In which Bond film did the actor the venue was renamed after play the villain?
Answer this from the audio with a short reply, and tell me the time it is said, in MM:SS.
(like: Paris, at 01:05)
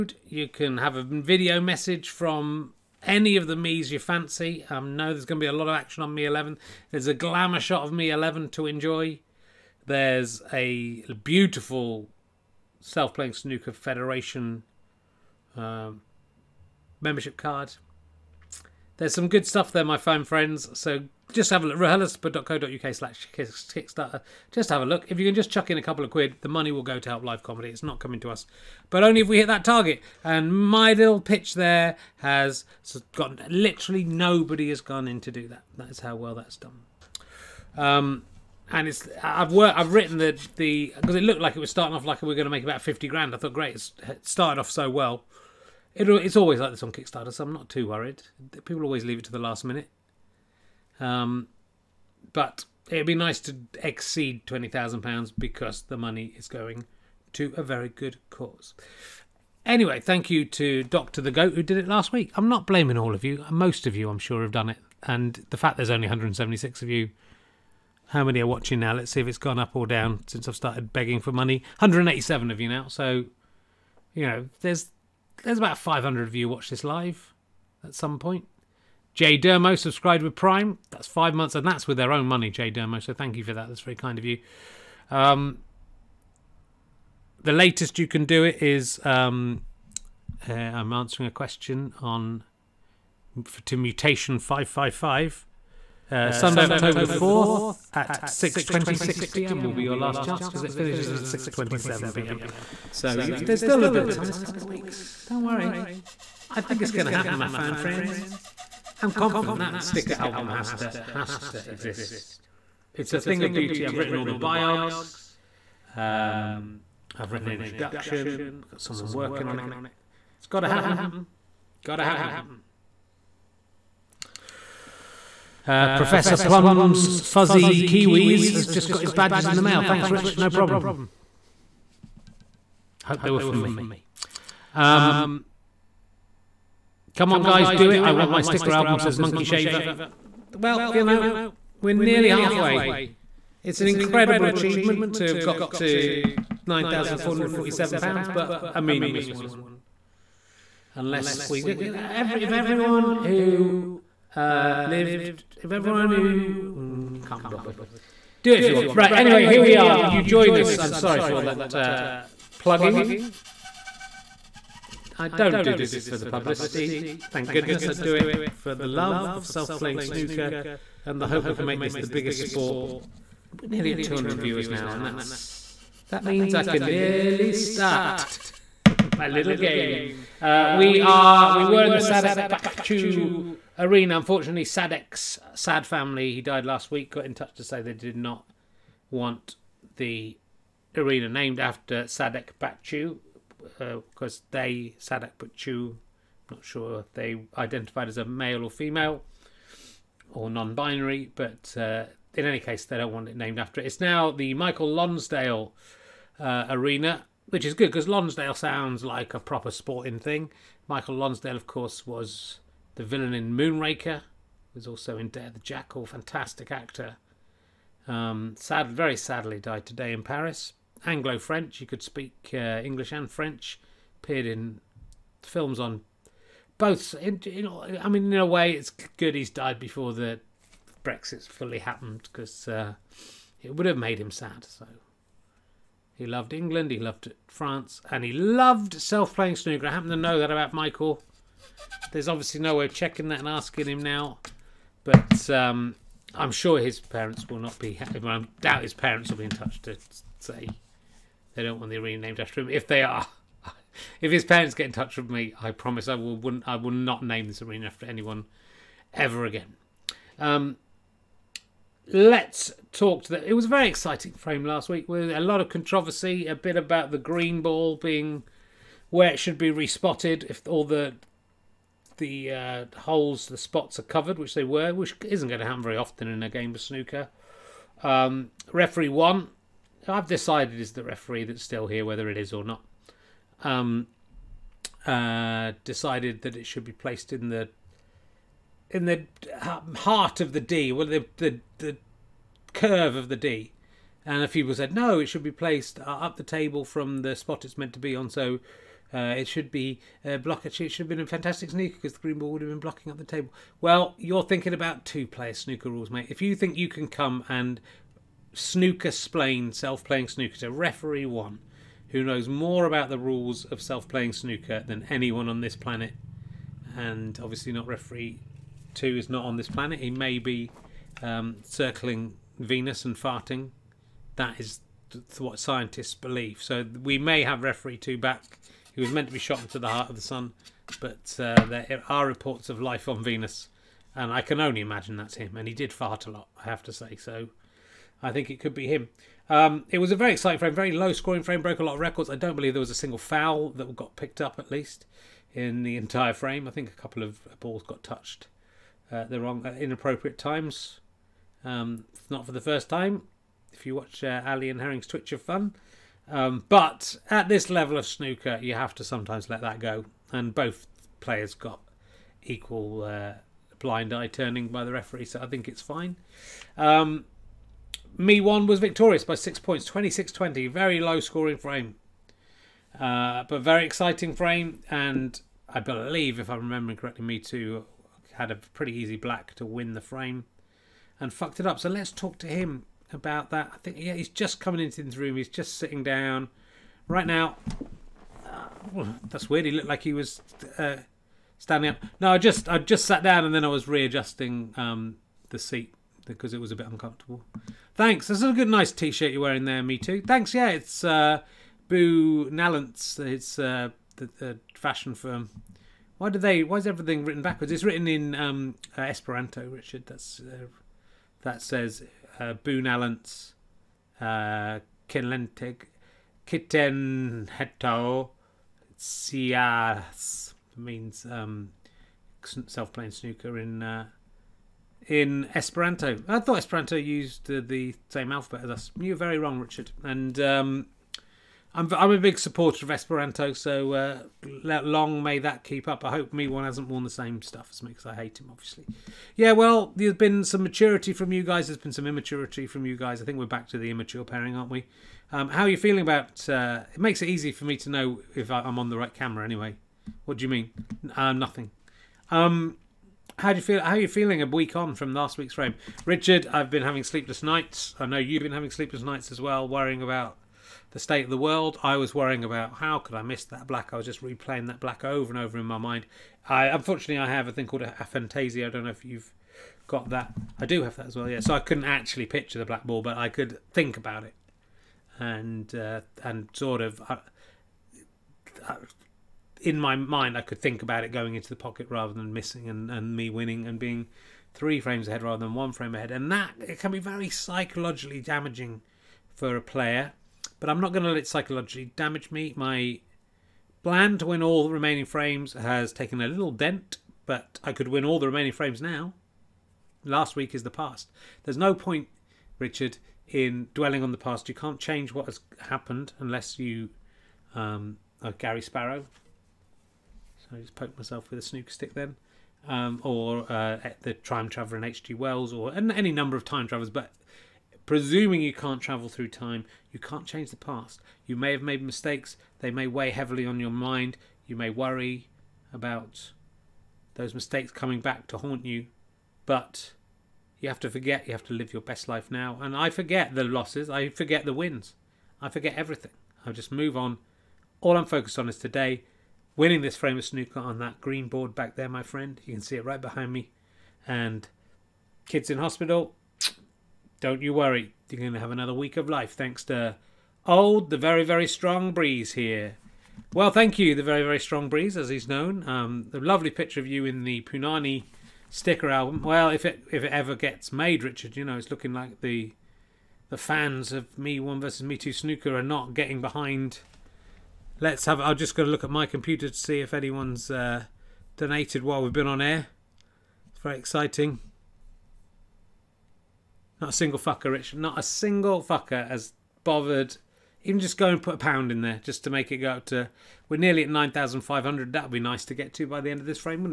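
Moonraker, at 03:33.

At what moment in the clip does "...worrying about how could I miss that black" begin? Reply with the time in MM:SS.
07:42.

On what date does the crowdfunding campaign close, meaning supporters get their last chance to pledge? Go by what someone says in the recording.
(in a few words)
Sunday, October the fourth.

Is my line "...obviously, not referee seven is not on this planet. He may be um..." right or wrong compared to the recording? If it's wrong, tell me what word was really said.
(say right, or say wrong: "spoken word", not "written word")
wrong: "two", not "seven".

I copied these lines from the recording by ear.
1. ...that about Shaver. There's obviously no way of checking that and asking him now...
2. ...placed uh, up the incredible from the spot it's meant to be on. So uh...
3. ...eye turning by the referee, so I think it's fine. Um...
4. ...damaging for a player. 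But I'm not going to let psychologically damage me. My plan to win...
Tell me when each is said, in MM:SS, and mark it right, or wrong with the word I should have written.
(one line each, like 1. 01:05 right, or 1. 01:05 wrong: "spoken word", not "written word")
1. 04:00 wrong: "Michael", not "Shaver"
2. 04:55 wrong: "table", not "incredible"
3. 06:04 right
4. 08:08 right.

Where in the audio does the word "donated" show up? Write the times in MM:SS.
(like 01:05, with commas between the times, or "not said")
09:31.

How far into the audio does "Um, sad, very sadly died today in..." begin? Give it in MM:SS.
03:38.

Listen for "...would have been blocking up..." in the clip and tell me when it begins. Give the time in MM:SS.
05:02.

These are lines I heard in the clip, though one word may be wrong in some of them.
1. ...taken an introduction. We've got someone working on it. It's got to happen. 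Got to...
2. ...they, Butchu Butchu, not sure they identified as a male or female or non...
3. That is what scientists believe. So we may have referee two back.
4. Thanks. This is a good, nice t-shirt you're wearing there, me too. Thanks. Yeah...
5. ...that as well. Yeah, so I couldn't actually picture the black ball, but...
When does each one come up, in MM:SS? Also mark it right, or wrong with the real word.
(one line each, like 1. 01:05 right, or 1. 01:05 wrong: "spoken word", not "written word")
1. 01:57 wrong: "written", not "taken"
2. 03:14 wrong: "Sadak", not "Butchu"
3. 05:24 right
4. 06:37 right
5. 07:50 right.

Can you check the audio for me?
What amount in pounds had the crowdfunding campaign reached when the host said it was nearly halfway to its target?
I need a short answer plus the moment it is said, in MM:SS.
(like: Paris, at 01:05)
£9,447, at 02:26.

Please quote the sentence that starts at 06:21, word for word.
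So let's talk to him about that.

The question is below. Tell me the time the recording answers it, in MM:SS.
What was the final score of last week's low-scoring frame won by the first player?
06:09.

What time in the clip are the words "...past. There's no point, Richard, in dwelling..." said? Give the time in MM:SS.
08:20.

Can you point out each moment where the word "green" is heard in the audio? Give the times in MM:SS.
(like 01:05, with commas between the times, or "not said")
04:27, 05:02, 09:01.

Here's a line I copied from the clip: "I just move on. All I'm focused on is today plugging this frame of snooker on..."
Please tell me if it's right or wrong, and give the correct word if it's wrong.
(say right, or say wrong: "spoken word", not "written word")
wrong: "winning", not "plugging".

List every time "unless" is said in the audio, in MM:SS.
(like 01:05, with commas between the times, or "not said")
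02:30, 08:26.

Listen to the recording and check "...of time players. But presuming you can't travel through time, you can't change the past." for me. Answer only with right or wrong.
wrong.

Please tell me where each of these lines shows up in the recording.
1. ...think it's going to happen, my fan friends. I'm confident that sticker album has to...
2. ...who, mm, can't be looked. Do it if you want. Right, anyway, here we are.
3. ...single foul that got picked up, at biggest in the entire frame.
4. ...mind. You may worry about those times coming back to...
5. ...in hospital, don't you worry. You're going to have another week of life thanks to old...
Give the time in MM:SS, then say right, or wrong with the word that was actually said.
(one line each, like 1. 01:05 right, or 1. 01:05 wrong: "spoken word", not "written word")
1. 01:46 right
2. 02:36 wrong: "bothered", not "looked"
3. 05:42 wrong: "least", not "biggest"
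4. 08:43 wrong: "mistakes", not "times"
5. 09:05 right.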